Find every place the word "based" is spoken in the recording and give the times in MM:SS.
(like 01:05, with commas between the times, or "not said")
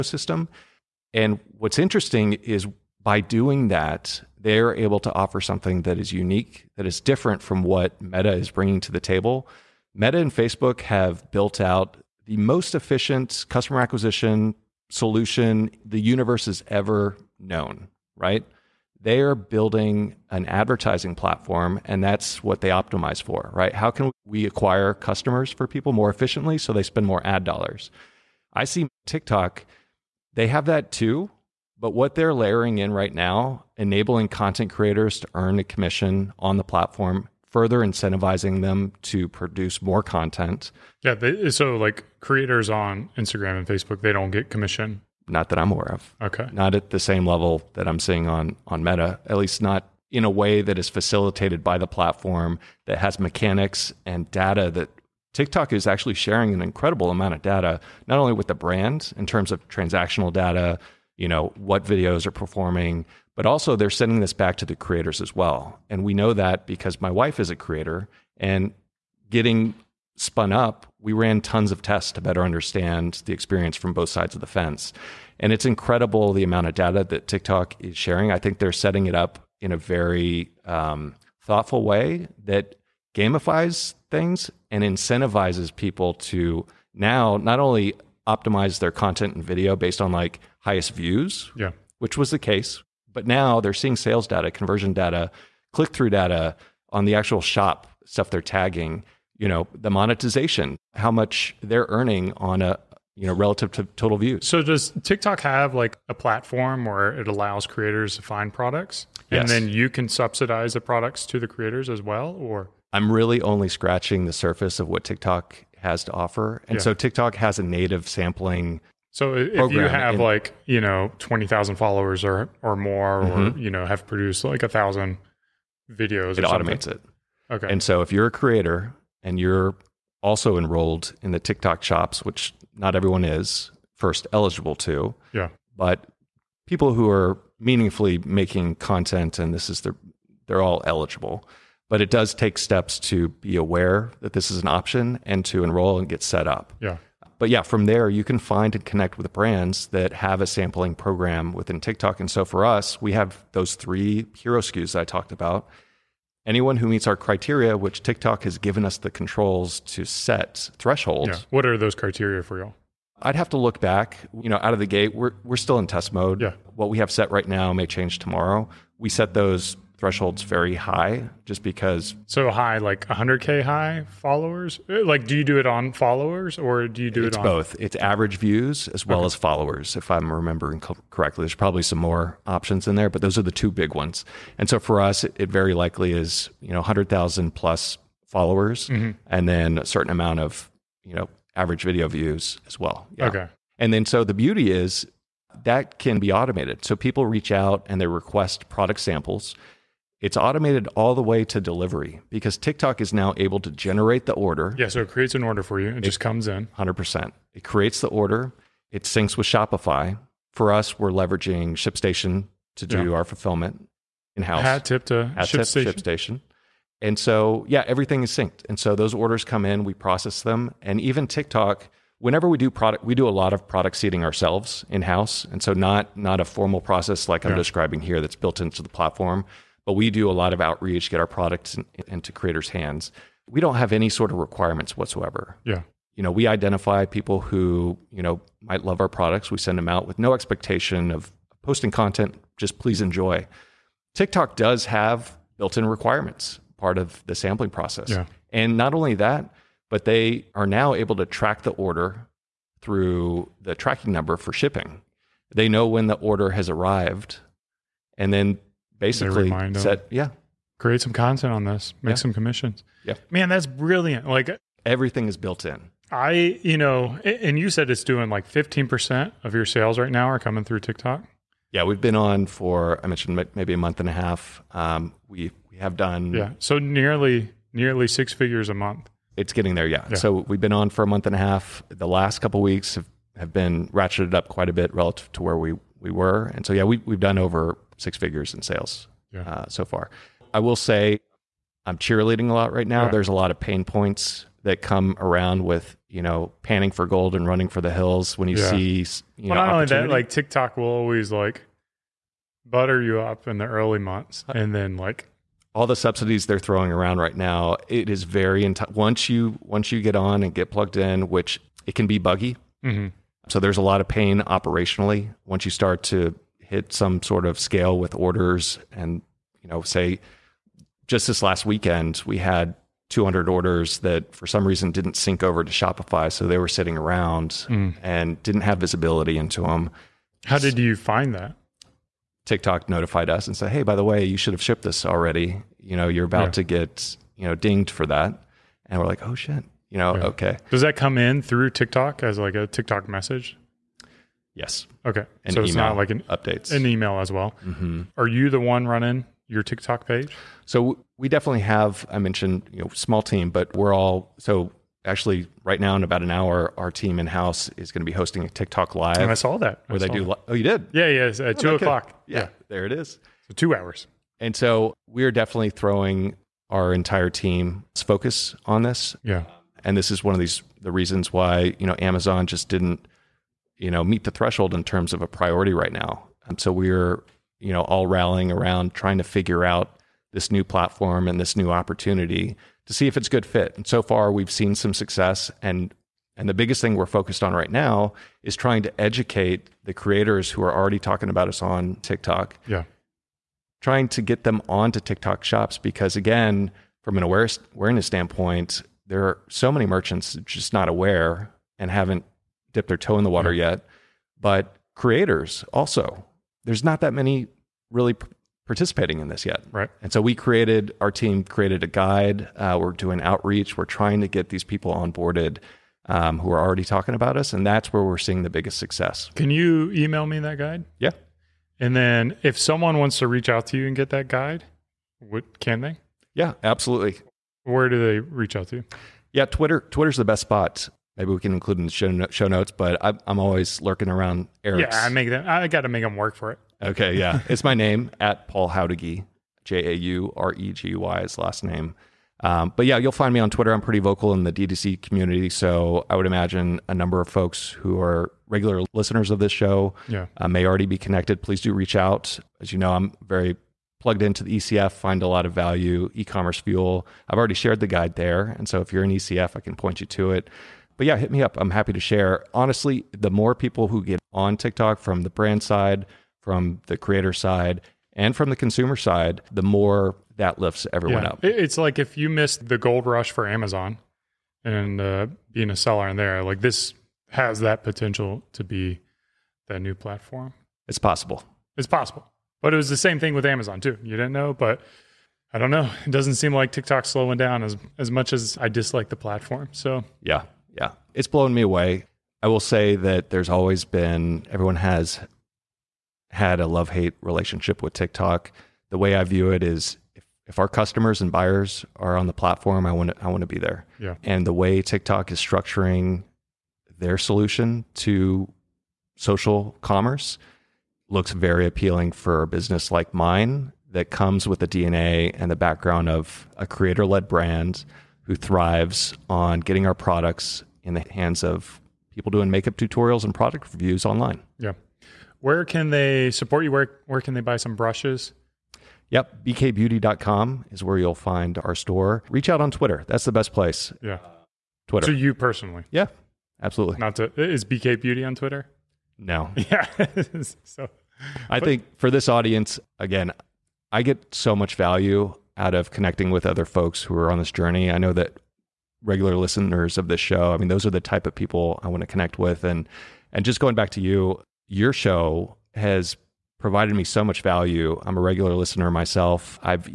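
01:29.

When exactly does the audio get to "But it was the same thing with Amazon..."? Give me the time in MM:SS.
08:02.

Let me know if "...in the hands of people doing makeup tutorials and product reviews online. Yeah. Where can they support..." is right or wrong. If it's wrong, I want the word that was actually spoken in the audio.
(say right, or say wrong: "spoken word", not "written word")
right.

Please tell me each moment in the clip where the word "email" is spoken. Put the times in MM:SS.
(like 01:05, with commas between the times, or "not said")
05:46, 06:59.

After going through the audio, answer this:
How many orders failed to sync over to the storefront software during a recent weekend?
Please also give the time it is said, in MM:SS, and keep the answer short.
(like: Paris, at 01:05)
200, at 05:23.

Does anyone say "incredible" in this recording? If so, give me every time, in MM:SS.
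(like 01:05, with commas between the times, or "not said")
00:56, 01:15.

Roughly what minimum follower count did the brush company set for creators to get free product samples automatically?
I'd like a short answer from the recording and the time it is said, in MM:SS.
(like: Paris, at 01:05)
100,000, at 03:06.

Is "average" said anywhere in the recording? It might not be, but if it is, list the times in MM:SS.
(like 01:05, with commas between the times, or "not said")
02:57, 03:11.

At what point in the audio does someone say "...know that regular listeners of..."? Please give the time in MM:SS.
09:07.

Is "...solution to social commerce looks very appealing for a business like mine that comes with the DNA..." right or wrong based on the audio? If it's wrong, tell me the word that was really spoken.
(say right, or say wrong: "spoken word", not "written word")
right.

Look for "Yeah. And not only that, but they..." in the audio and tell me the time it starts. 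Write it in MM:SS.
04:08.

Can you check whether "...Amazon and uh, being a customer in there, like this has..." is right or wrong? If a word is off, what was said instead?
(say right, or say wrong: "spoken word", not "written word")
wrong: "seller", not "customer".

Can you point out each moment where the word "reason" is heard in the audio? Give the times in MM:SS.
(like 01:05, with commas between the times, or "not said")
05:24, 06:10.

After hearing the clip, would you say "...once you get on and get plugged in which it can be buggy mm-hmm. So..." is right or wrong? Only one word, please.
right.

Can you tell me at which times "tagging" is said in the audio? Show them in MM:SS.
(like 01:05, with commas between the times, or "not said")
01:38.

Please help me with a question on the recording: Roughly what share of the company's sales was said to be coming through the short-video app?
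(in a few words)
15%.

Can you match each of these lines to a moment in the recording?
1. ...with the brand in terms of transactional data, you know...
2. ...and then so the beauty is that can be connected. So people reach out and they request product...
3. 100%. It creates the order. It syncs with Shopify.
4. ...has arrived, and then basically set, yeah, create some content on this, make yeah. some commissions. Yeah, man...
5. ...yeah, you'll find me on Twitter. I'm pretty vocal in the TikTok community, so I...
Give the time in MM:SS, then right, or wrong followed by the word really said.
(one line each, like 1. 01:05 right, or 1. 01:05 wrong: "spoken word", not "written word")
1. 00:58 right
2. 03:13 wrong: "automated", not "connected"
3. 03:26 right
4. 04:16 right
5. 07:22 wrong: "DTC", not "TikTok".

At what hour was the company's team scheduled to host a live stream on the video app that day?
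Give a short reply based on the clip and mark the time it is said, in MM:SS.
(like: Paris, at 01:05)
two o'clock, at 06:01.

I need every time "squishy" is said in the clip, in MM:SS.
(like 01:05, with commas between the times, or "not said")
not said.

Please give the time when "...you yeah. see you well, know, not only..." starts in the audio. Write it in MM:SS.
04:58.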